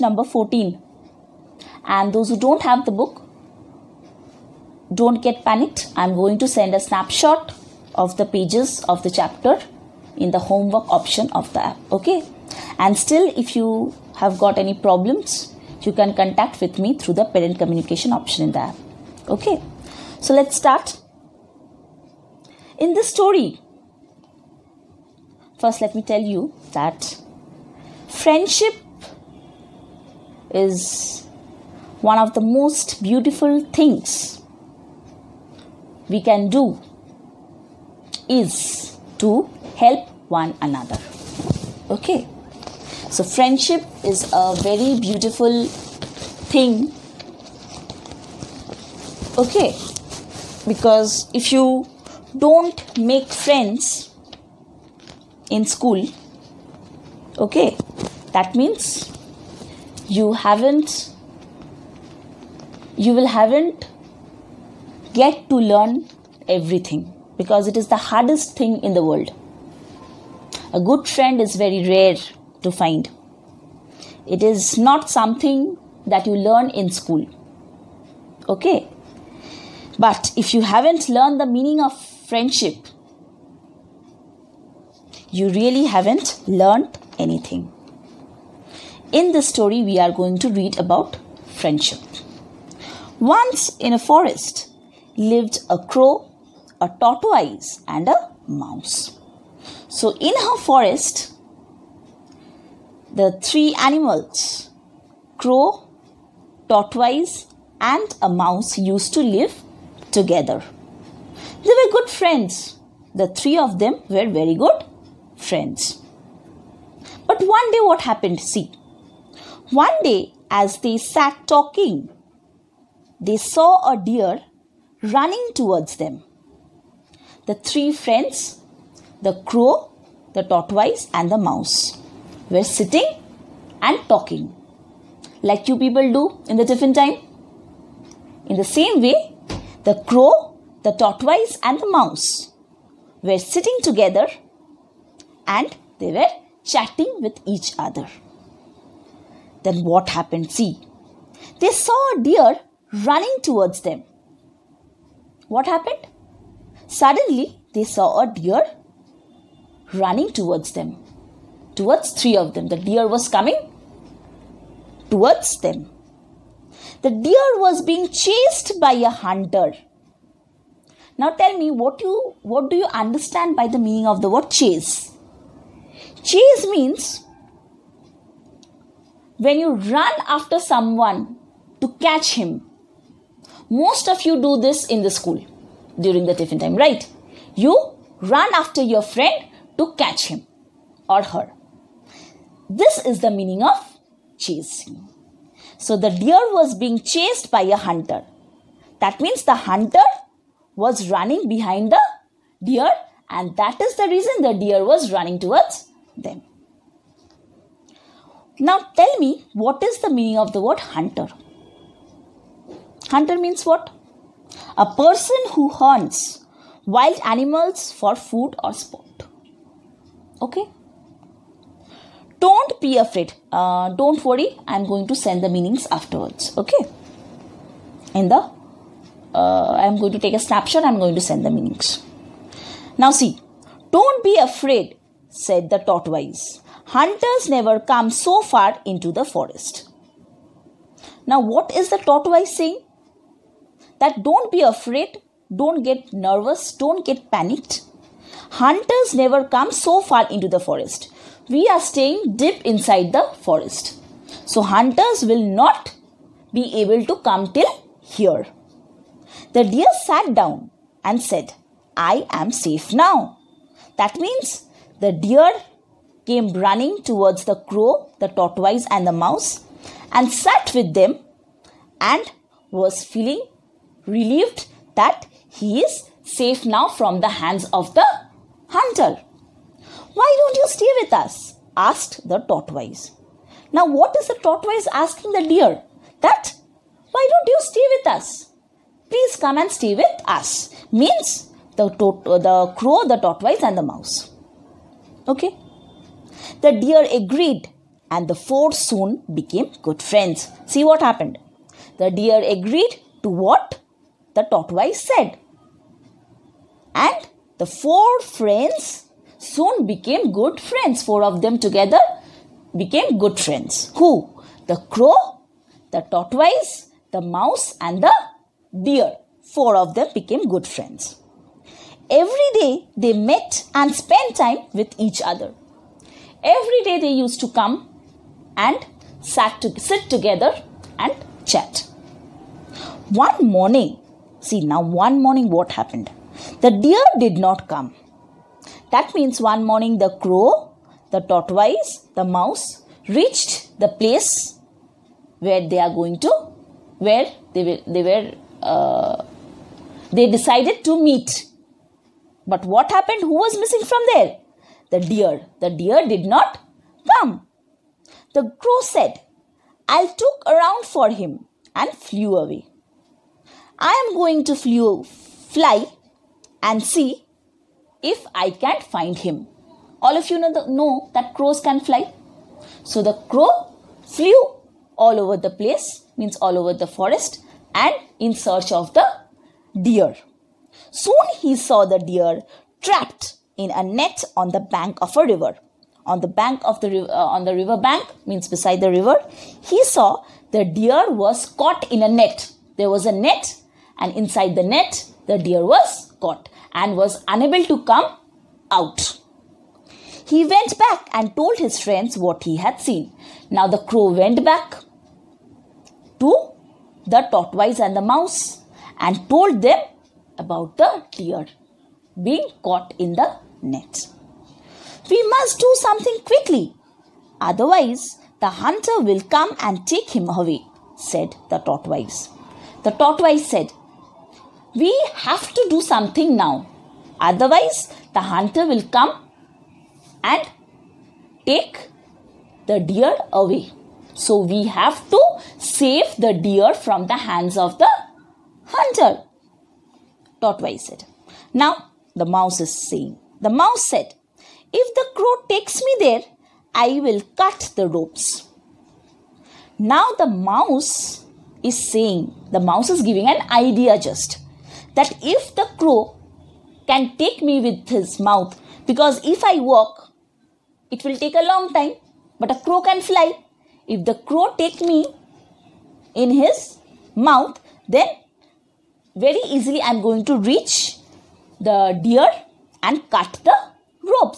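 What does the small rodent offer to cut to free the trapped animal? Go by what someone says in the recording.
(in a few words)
The ropes.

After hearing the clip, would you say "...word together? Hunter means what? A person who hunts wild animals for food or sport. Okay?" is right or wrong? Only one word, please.
wrong.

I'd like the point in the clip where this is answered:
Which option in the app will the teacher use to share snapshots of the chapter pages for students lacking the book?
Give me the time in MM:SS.
00:10.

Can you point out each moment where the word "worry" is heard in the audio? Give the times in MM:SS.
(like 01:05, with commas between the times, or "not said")
03:44.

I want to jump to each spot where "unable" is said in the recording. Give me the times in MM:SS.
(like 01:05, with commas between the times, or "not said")
06:37.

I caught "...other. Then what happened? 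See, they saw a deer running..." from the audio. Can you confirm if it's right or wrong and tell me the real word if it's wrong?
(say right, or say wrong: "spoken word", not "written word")
right.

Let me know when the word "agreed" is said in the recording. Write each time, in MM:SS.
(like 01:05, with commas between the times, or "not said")
04:57, 05:02.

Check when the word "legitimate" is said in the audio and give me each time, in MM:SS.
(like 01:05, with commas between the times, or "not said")
not said.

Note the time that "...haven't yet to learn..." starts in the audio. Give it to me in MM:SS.
01:03.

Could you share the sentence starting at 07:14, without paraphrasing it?
So, we have to save the deer from the hands of the hunter.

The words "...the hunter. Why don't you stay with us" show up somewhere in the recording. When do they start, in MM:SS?
04:37.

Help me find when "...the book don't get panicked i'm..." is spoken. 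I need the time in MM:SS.
00:02.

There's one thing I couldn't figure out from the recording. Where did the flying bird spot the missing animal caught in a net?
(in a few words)
On the bank of a river.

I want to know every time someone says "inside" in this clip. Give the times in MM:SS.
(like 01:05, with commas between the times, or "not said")
04:12, 06:34.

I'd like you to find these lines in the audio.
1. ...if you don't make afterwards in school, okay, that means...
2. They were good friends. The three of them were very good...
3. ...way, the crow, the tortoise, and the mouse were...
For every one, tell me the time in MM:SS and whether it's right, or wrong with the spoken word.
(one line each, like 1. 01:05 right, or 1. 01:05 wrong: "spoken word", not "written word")
1. 00:51 wrong: "friends", not "afterwards"
2. 01:51 right
3. 02:19 right.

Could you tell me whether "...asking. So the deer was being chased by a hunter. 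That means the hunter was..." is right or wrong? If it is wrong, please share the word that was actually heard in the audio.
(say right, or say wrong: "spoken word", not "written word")
wrong: "chasing", not "asking".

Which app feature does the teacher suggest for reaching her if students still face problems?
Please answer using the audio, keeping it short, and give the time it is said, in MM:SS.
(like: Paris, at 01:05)
Parent communication option, at 00:17.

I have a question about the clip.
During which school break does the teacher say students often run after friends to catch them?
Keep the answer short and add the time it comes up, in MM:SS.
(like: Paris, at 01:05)
Tiffin time, at 03:06.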